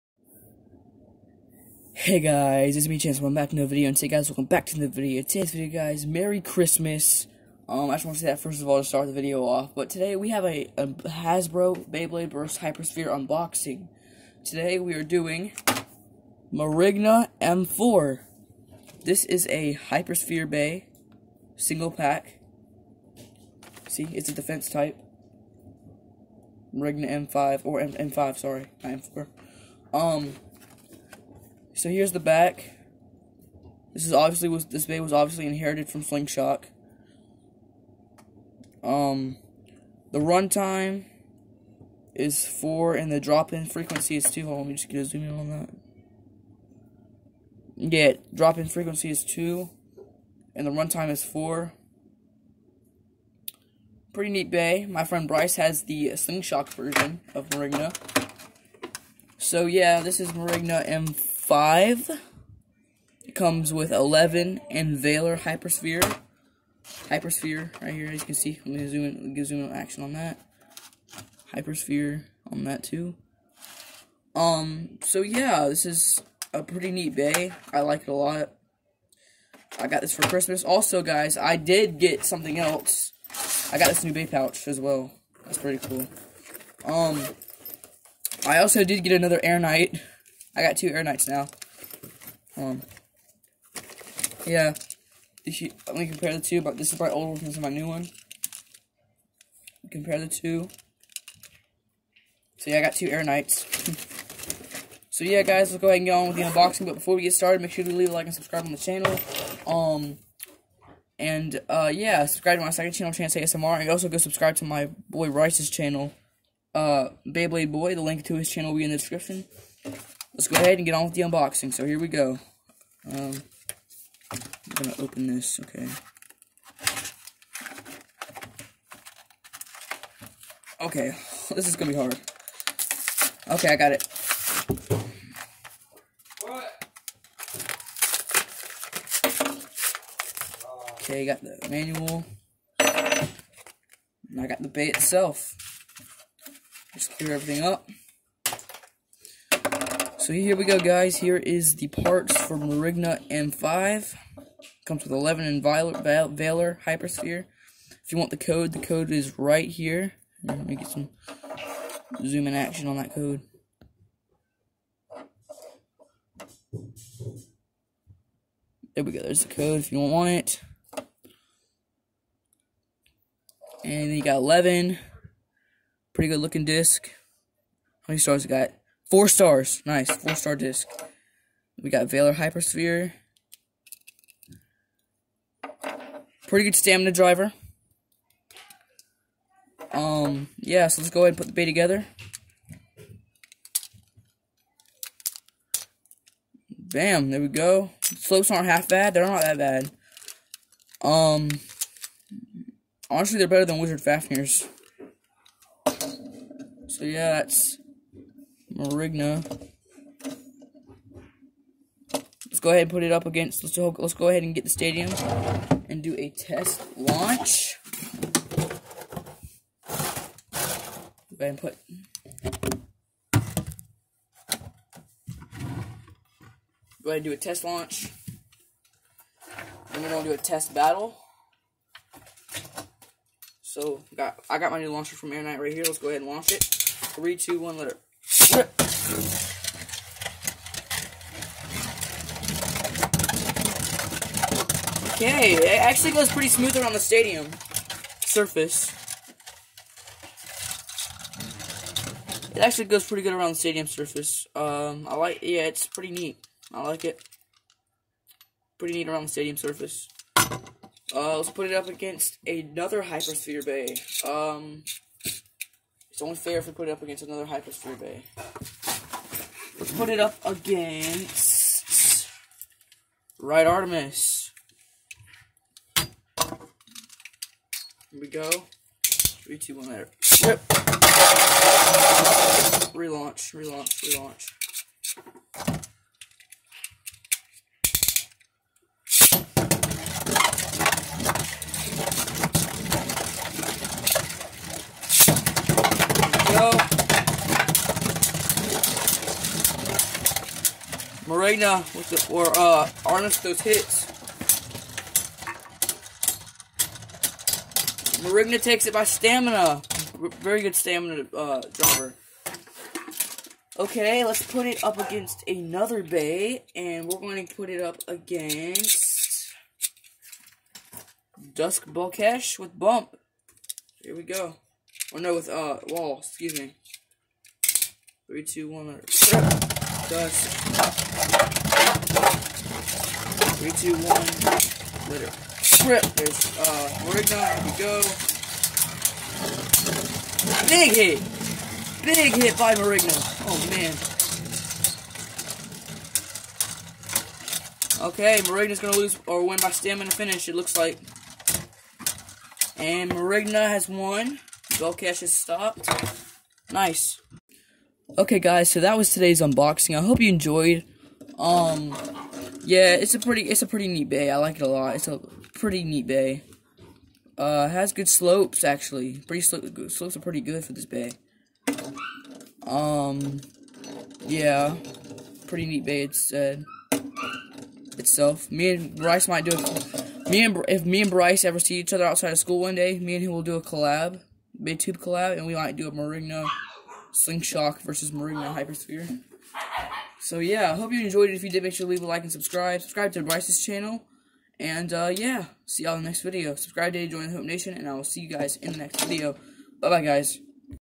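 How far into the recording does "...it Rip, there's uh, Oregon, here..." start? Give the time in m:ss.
5:35.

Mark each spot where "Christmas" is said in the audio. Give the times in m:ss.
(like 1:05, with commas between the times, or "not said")
0:06, 1:20.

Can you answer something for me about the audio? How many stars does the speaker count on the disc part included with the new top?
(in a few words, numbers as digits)
4.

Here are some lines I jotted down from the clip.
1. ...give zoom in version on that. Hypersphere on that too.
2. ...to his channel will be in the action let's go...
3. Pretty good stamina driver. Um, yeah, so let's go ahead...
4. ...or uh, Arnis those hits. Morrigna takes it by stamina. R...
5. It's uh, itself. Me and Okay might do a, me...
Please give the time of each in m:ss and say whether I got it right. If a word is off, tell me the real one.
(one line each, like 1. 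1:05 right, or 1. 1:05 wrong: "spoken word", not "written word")
1. 1:09 wrong: "action", not "version"
2. 1:58 wrong: "description", not "action"
3. 3:06 right
4. 5:02 right
5. 6:16 wrong: "Bryce", not "Okay".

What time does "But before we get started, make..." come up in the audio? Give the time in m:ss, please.
1:46.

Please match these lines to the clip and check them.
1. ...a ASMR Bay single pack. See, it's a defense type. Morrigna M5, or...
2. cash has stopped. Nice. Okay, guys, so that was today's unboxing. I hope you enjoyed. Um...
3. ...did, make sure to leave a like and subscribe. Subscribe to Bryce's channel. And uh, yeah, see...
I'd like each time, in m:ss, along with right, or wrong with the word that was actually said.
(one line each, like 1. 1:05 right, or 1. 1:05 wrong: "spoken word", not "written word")
1. 0:19 wrong: "Hypersphere", not "ASMR"
2. 5:54 right
3. 6:31 right.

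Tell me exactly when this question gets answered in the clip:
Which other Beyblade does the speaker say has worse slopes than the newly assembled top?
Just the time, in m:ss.
3:23.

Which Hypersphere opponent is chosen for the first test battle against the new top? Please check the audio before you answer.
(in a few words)
Right Artemis.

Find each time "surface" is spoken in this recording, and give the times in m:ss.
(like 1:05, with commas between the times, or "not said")
4:08, 4:13, 4:19.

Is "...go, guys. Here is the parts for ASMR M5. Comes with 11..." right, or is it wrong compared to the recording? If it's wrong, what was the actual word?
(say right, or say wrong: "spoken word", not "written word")
wrong: "Morrigna", not "ASMR".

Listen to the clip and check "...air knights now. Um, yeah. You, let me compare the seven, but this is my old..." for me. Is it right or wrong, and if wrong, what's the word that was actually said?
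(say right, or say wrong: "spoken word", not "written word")
wrong: "two", not "seven".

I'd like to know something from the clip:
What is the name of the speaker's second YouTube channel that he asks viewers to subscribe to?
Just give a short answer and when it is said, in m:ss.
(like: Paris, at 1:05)
Chance ASMR, at 1:53.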